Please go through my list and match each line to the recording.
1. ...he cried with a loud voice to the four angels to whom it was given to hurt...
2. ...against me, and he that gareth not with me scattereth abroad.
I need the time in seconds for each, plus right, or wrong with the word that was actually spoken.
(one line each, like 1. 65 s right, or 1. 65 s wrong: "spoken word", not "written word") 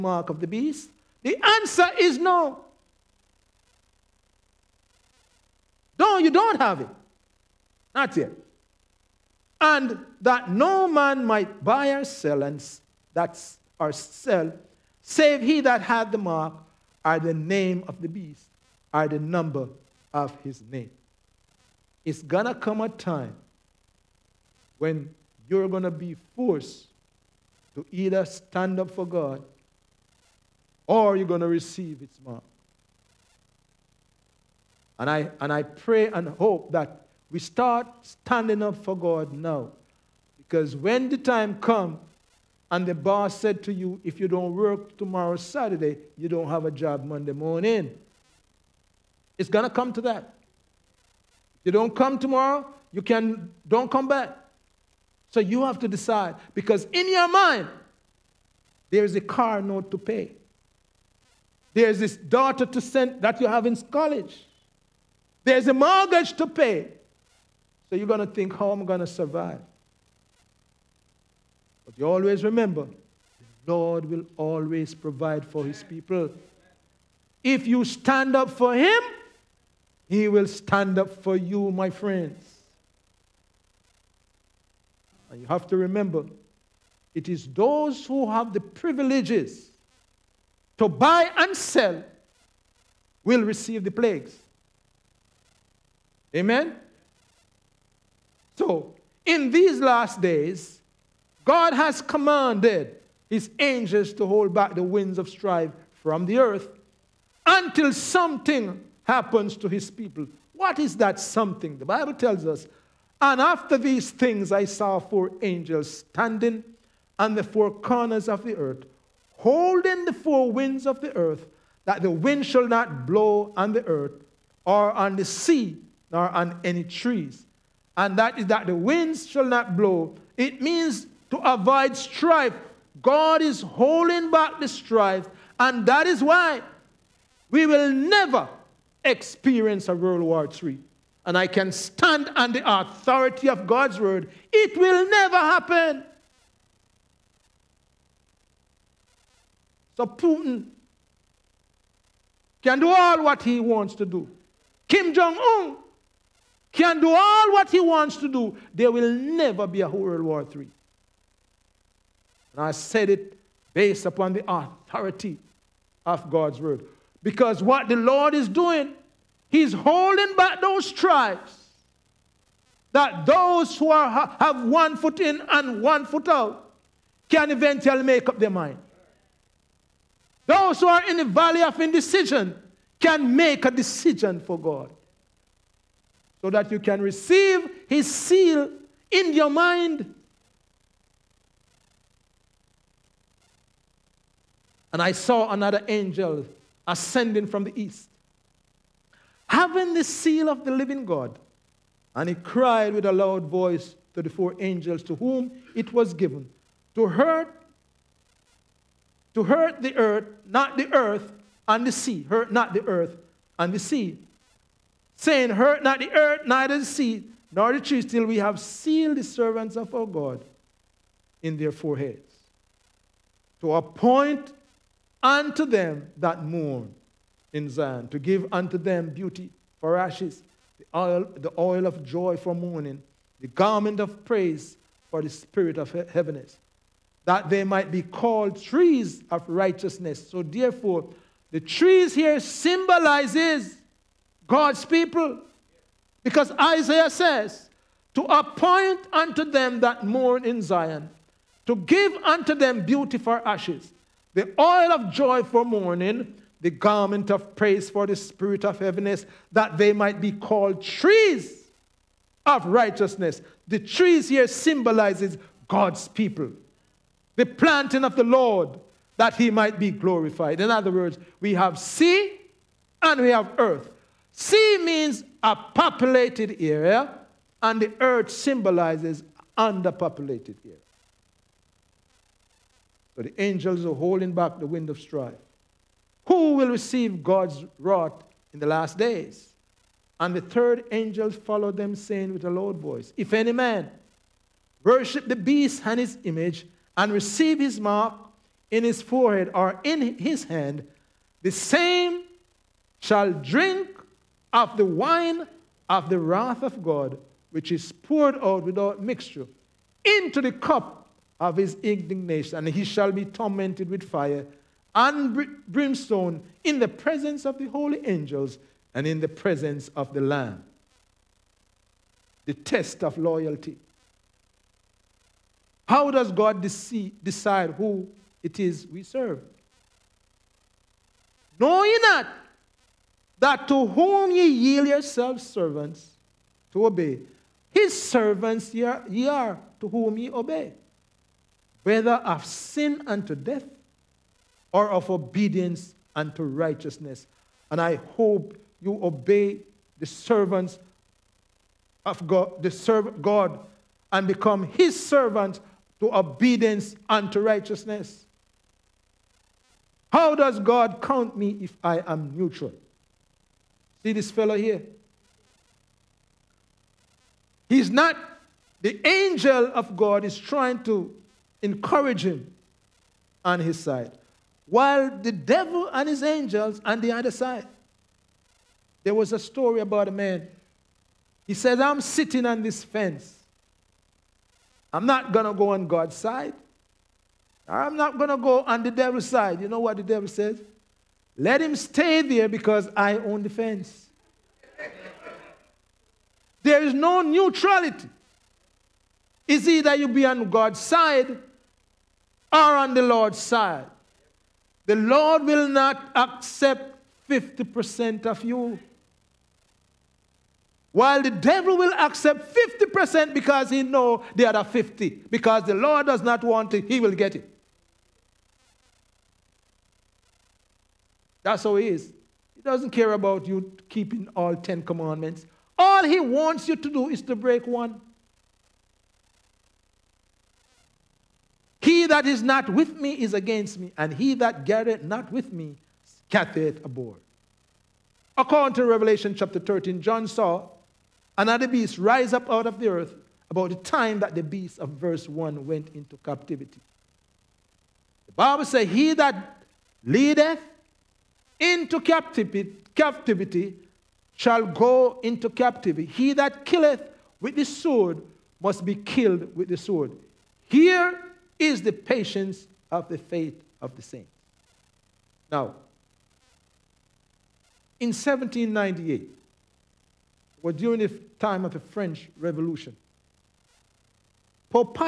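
1. 202 s right
2. 433 s right.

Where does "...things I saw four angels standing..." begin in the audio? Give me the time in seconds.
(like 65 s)
114 s.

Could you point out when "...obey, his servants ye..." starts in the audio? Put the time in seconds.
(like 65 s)
336 s.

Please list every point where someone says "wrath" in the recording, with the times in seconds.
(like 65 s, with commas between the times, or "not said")
287 s, 306 s.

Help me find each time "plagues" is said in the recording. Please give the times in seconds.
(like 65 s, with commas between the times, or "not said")
93 s.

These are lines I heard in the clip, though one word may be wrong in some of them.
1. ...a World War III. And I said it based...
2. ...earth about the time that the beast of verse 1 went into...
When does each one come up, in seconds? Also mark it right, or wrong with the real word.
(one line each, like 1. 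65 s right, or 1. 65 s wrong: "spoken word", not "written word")
1. 159 s right
2. 442 s right.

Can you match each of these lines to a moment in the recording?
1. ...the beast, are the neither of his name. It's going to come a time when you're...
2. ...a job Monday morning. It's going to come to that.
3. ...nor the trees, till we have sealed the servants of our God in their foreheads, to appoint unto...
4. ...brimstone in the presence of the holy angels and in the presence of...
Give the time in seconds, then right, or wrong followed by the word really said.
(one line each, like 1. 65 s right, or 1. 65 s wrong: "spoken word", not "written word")
1. 18 s wrong: "number", not "neither"
2. 46 s right
3. 217 s right
4. 315 s right.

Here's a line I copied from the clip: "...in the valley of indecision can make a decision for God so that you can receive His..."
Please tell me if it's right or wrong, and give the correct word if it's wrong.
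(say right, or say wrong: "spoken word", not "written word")
right.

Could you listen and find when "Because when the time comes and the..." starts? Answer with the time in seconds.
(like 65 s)
40 s.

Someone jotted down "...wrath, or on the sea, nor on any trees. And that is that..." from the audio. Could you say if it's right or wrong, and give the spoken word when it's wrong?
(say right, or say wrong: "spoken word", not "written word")
wrong: "earth", not "wrath".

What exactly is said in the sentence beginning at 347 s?
And I hope you obey the servants of God, the serve God, and become his servant to obedience unto righteousness.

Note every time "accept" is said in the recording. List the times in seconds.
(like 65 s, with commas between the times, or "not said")
406 s, 411 s.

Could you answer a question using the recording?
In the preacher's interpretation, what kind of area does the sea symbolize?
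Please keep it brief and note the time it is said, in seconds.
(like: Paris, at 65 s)
a populated area, at 275 s.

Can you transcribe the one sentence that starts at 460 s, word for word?
Here is the patience of the faith of the saints.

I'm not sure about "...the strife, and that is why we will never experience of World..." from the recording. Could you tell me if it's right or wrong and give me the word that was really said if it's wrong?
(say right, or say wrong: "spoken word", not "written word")
right.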